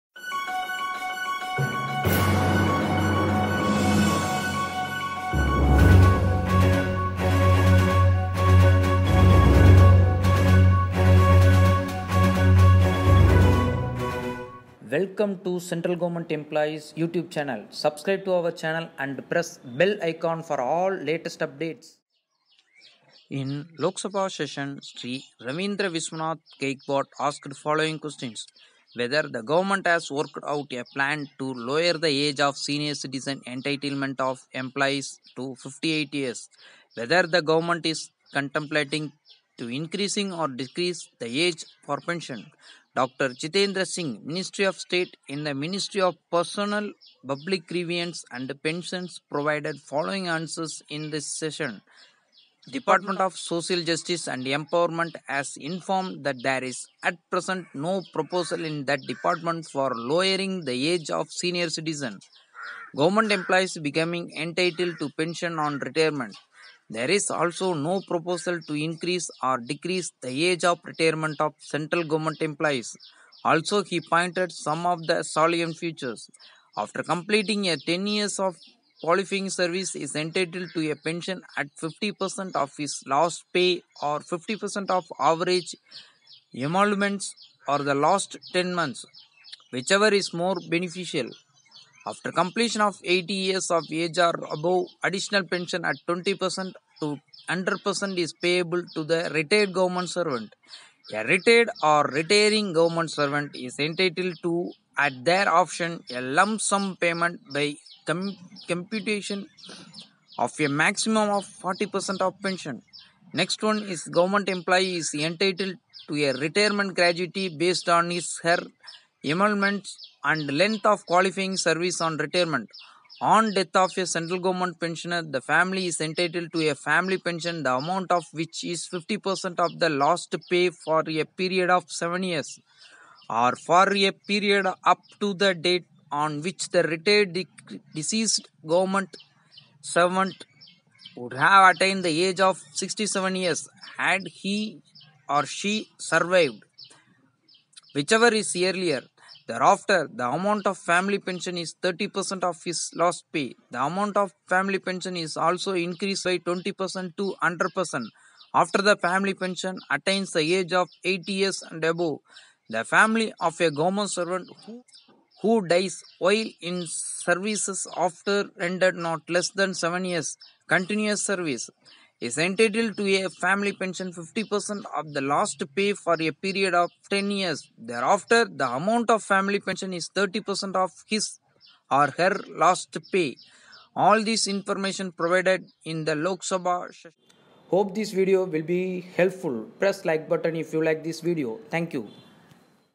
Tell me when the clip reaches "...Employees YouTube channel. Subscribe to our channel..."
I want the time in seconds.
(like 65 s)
16 s.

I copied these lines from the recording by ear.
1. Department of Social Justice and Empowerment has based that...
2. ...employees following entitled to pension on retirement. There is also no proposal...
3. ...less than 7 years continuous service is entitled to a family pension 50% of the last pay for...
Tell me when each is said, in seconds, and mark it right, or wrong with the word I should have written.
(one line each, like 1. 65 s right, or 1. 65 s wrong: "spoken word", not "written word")
1. 52 s wrong: "informed", not "based"
2. 63 s wrong: "becoming", not "following"
3. 169 s right.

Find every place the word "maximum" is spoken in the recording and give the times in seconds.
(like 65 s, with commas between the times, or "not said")
110 s.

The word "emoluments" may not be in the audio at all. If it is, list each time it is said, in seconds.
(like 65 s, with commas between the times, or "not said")
86 s, 119 s.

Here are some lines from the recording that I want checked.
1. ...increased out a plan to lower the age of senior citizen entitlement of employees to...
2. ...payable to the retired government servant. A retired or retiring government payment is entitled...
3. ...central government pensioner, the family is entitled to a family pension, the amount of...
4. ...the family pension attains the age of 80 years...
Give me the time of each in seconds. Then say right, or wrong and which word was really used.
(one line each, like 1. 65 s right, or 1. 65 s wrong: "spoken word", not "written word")
1. 30 s wrong: "worked", not "increased"
2. 98 s wrong: "servant", not "payment"
3. 124 s right
4. 158 s right.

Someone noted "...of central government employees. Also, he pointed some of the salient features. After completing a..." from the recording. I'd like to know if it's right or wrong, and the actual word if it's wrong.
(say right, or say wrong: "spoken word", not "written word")
right.